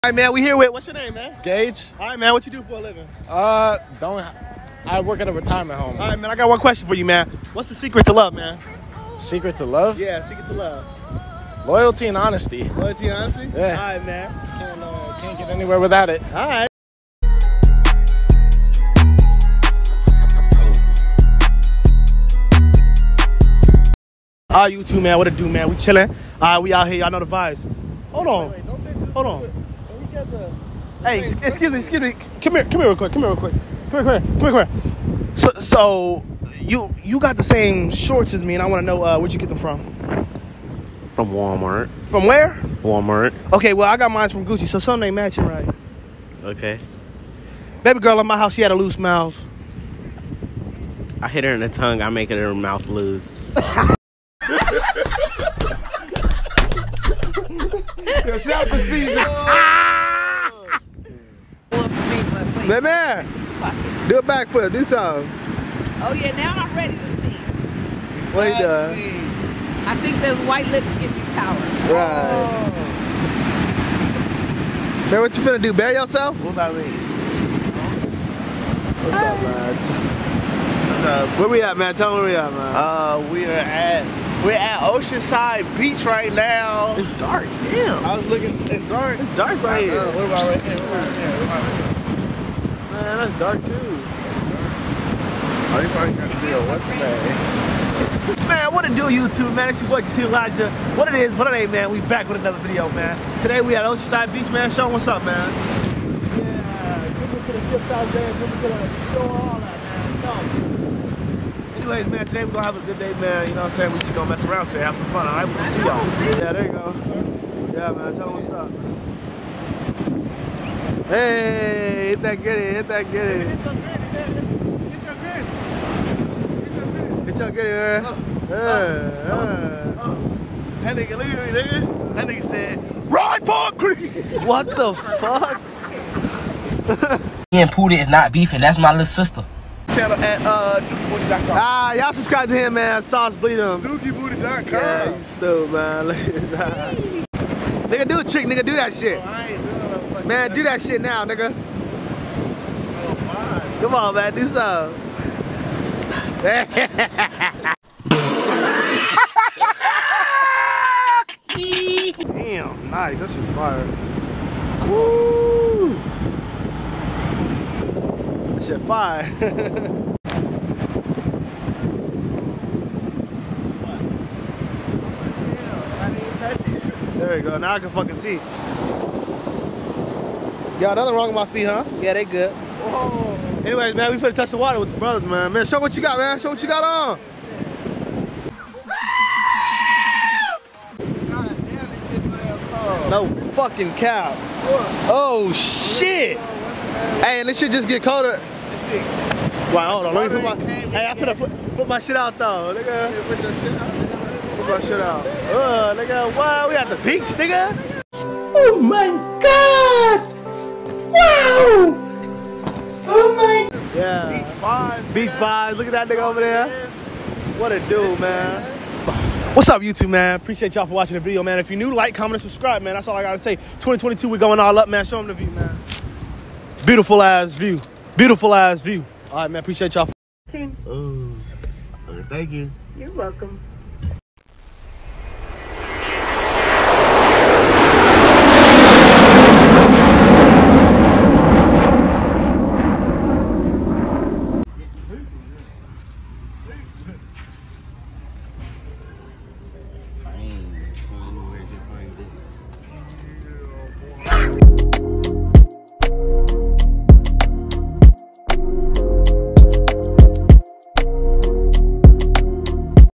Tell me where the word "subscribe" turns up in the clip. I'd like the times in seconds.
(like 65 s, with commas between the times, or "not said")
142 s, 222 s.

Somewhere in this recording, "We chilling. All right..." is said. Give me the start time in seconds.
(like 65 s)
25 s.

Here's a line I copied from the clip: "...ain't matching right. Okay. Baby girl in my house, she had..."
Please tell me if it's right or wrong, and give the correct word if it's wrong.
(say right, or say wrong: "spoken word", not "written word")
right.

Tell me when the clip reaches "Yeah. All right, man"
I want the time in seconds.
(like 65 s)
13 s.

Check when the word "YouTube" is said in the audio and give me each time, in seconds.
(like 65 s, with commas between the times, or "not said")
99 s, 219 s.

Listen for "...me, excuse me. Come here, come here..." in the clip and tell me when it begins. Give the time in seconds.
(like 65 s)
31 s.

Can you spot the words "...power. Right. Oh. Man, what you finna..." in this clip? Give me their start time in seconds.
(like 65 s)
71 s.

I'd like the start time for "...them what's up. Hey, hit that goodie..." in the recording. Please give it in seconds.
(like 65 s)
118 s.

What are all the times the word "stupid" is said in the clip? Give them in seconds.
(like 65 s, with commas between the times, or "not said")
145 s.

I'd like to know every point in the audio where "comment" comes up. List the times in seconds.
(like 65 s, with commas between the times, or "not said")
222 s.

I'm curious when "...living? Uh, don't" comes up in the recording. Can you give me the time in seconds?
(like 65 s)
2 s.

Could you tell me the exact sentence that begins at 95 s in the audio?
Are you probably gonna be a Wednesday?